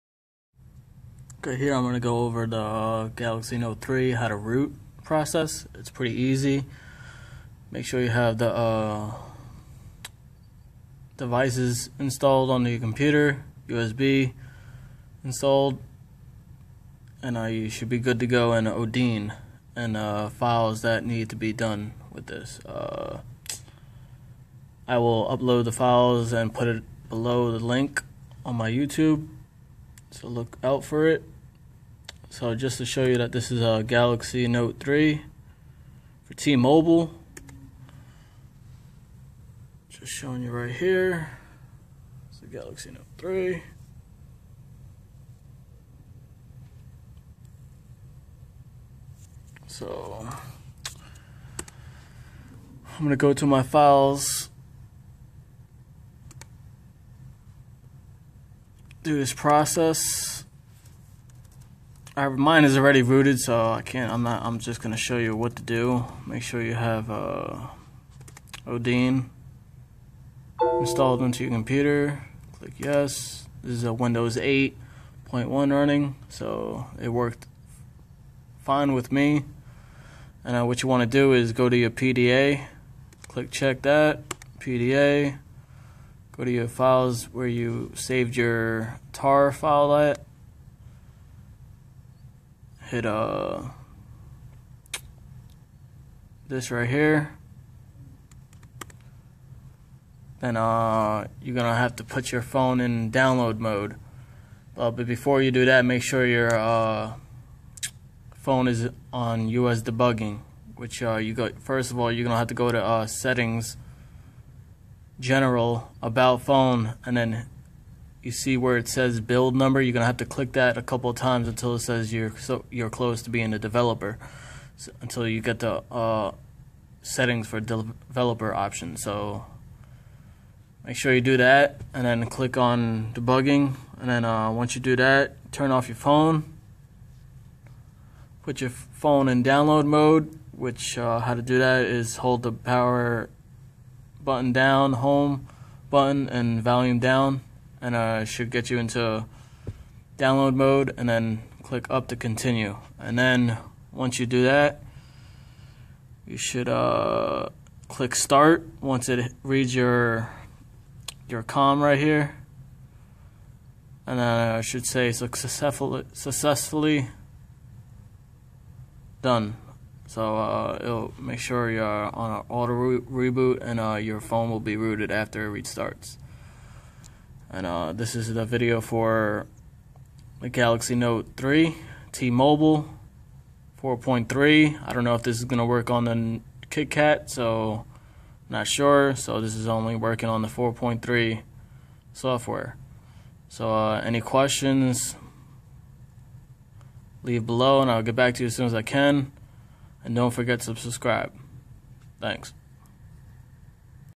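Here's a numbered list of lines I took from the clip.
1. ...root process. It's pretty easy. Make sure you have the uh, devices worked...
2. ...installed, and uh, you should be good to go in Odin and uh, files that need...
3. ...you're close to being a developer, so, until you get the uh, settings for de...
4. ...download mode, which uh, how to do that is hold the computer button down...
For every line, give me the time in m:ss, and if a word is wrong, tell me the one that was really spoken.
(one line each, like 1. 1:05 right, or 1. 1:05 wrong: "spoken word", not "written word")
1. 0:04 wrong: "installed", not "worked"
2. 0:15 right
3. 2:02 right
4. 2:19 wrong: "power", not "computer".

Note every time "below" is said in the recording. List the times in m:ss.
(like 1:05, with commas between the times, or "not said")
0:27, 3:17.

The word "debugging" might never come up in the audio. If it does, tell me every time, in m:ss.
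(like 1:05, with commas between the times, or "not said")
1:49, 2:13.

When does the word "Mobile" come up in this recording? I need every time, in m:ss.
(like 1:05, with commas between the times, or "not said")
0:36, 3:02.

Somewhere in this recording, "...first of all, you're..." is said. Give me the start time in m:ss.
1:51.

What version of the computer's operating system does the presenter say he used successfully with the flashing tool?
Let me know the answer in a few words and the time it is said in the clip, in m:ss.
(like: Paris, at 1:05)
Windows 8.1, at 1:13.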